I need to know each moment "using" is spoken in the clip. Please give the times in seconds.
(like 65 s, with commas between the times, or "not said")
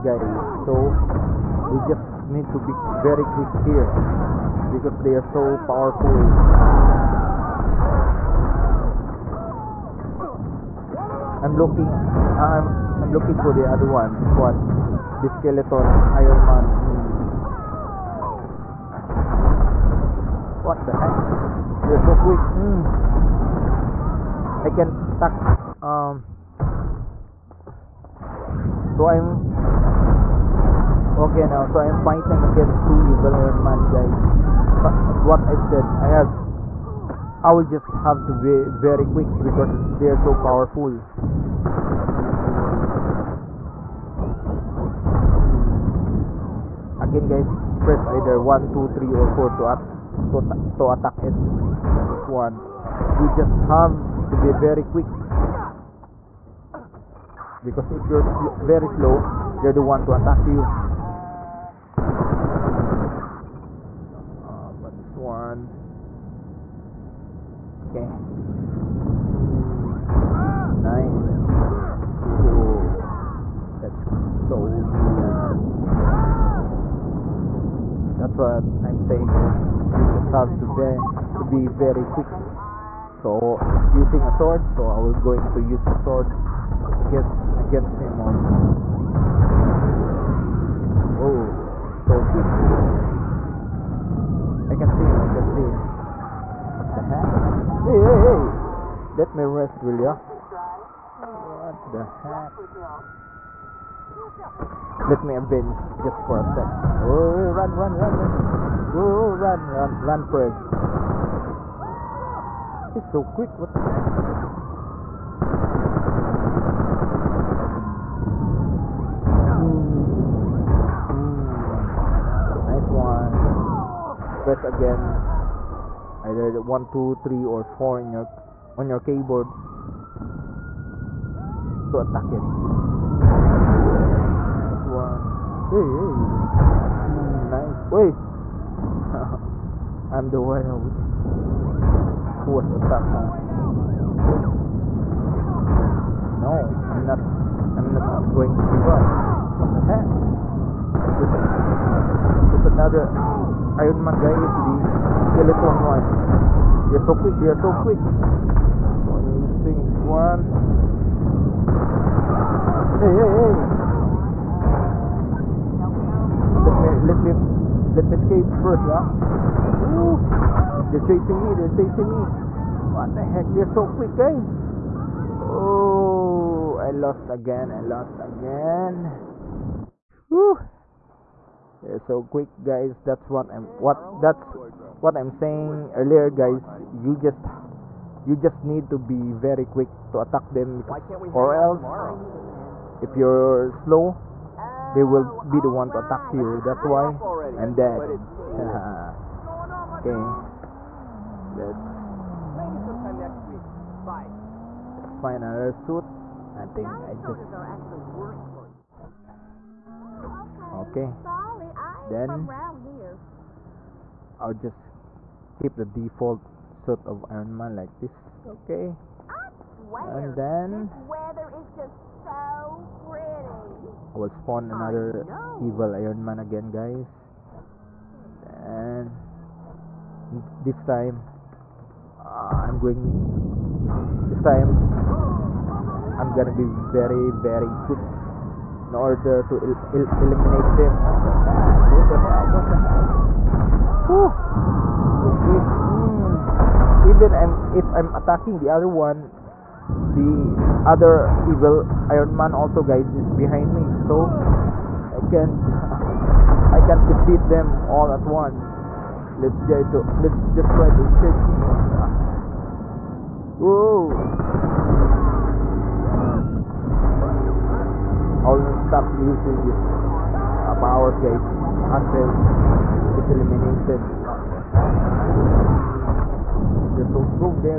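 83 s, 159 s, 269 s.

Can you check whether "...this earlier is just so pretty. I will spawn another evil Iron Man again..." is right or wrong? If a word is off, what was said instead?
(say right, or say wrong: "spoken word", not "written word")
wrong: "weather", not "earlier".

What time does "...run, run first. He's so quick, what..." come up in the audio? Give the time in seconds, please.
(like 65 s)
109 s.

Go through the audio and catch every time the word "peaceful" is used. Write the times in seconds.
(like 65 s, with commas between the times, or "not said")
not said.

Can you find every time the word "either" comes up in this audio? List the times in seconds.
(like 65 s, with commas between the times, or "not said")
48 s, 126 s.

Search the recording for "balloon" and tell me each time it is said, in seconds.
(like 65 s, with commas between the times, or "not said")
not said.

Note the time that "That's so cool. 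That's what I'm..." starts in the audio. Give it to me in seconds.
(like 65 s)
73 s.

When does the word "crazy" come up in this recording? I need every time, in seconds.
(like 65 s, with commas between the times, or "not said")
95 s.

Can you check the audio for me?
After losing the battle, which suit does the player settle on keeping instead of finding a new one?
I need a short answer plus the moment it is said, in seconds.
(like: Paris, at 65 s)
Default suit, at 215 s.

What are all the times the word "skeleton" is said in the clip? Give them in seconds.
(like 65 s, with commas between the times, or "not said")
15 s, 155 s.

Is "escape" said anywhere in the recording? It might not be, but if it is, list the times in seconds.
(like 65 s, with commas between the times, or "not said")
168 s, 261 s.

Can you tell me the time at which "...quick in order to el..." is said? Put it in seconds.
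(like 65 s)
237 s.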